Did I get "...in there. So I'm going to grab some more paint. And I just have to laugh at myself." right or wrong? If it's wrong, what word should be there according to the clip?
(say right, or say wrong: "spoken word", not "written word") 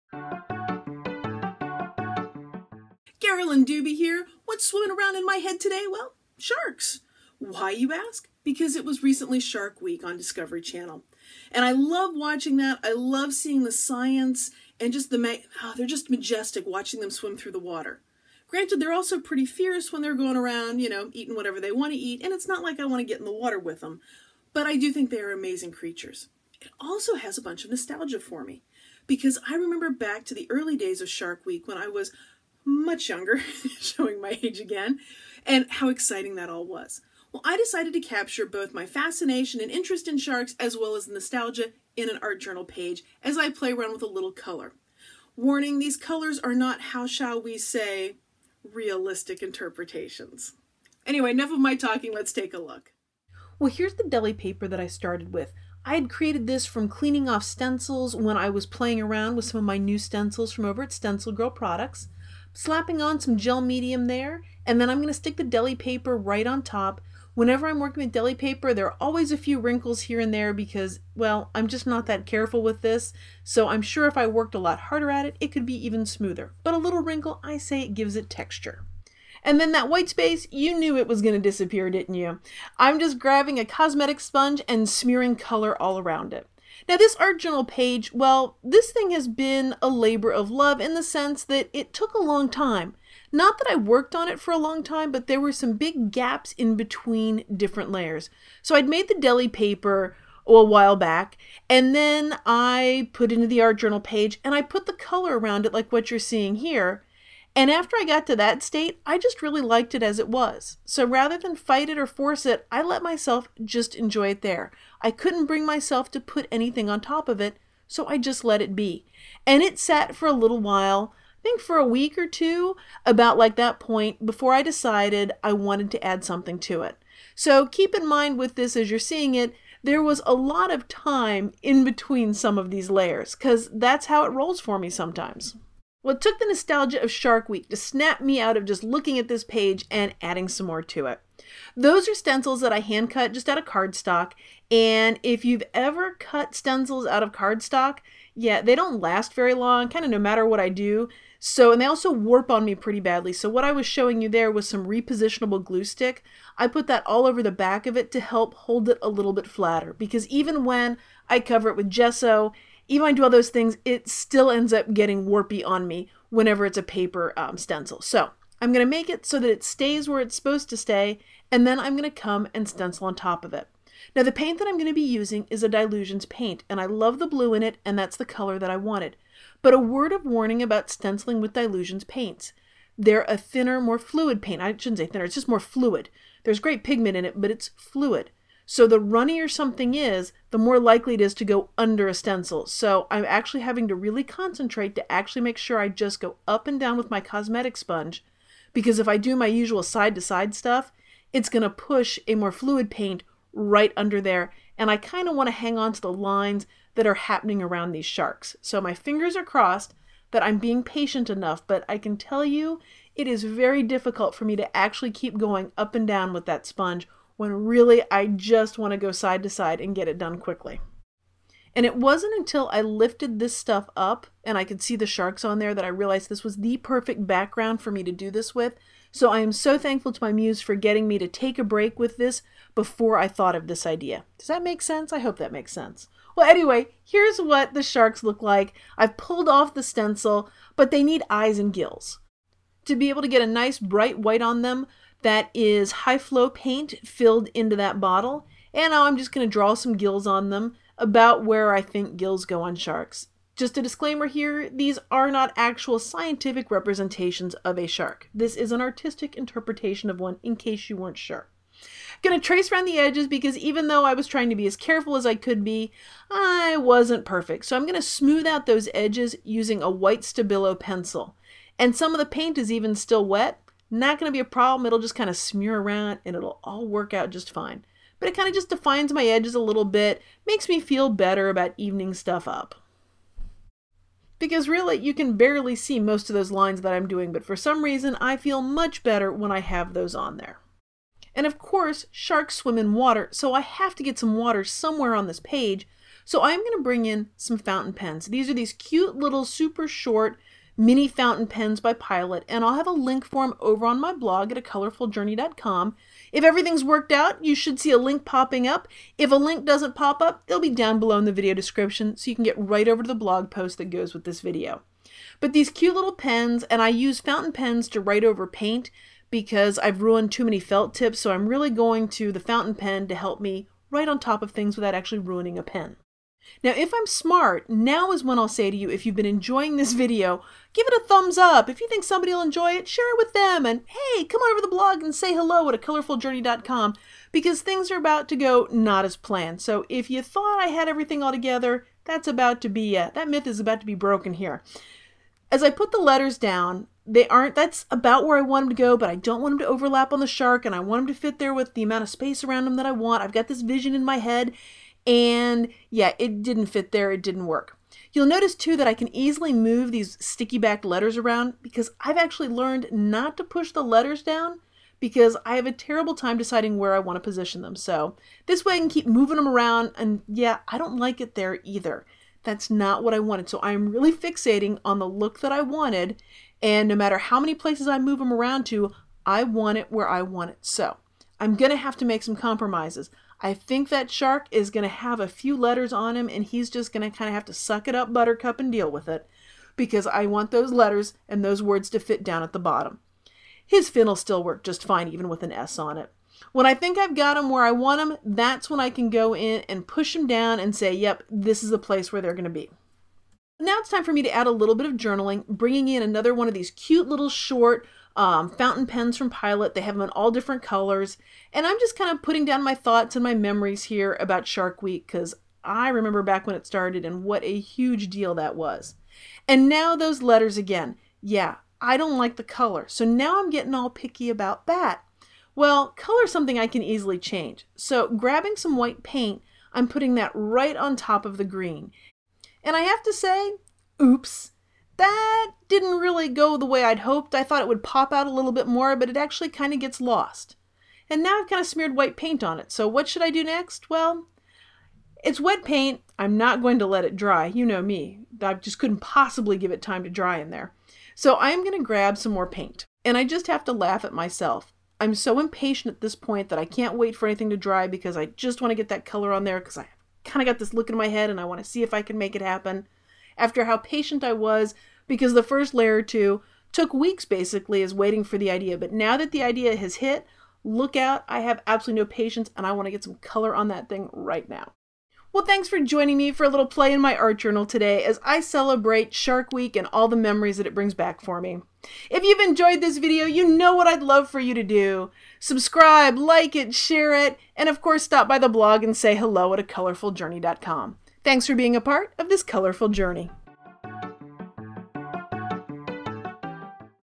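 right.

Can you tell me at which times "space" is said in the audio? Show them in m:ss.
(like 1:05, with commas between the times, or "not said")
1:20, 5:52.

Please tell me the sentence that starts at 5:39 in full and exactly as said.
So if you thought I had everything all together, that's about to be, uh, that myth is about to be broken here.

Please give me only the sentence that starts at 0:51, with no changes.
Anyway, enough of my talking, let's take a look.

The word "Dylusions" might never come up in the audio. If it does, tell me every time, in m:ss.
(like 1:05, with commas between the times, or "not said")
2:55, 3:01.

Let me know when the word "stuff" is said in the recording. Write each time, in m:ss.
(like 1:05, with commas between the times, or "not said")
3:20, 3:43, 4:42.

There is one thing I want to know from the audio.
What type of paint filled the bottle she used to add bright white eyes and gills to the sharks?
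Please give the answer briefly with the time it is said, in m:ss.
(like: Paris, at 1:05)
high flow paint, at 4:05.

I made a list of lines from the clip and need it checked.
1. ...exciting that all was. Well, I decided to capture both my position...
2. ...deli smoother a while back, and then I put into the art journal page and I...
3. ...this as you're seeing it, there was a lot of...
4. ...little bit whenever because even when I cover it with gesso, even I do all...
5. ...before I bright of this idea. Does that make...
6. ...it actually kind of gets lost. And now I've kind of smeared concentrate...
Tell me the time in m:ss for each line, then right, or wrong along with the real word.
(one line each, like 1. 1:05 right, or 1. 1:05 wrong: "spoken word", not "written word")
1. 0:35 wrong: "fascination", not "position"
2. 1:39 wrong: "paper", not "smoother"
3. 2:08 right
4. 2:39 wrong: "flatter", not "whenever"
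5. 3:52 wrong: "thought", not "bright"
6. 7:19 wrong: "white", not "concentrate".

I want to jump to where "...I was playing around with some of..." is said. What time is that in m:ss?
0:58.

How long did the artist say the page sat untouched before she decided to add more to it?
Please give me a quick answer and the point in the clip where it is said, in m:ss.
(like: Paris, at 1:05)
a week or two, at 2:01.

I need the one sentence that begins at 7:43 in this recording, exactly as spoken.
After how patient I was because the first layer or two took weeks basically is waiting for the idea.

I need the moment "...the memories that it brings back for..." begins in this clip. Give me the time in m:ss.
8:00.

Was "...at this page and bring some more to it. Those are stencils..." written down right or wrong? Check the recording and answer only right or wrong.
wrong.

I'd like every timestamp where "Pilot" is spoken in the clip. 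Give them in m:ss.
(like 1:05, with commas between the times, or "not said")
5:01, 6:49.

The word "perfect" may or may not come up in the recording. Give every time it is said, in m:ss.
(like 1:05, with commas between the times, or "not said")
3:46, 4:27.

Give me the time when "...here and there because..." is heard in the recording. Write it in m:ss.
1:10.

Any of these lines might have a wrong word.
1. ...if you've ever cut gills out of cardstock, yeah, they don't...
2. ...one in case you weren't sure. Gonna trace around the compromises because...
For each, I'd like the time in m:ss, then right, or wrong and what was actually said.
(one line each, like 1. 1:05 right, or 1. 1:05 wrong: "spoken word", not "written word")
1. 2:25 wrong: "stencils", not "gills"
2. 4:20 wrong: "edges", not "compromises".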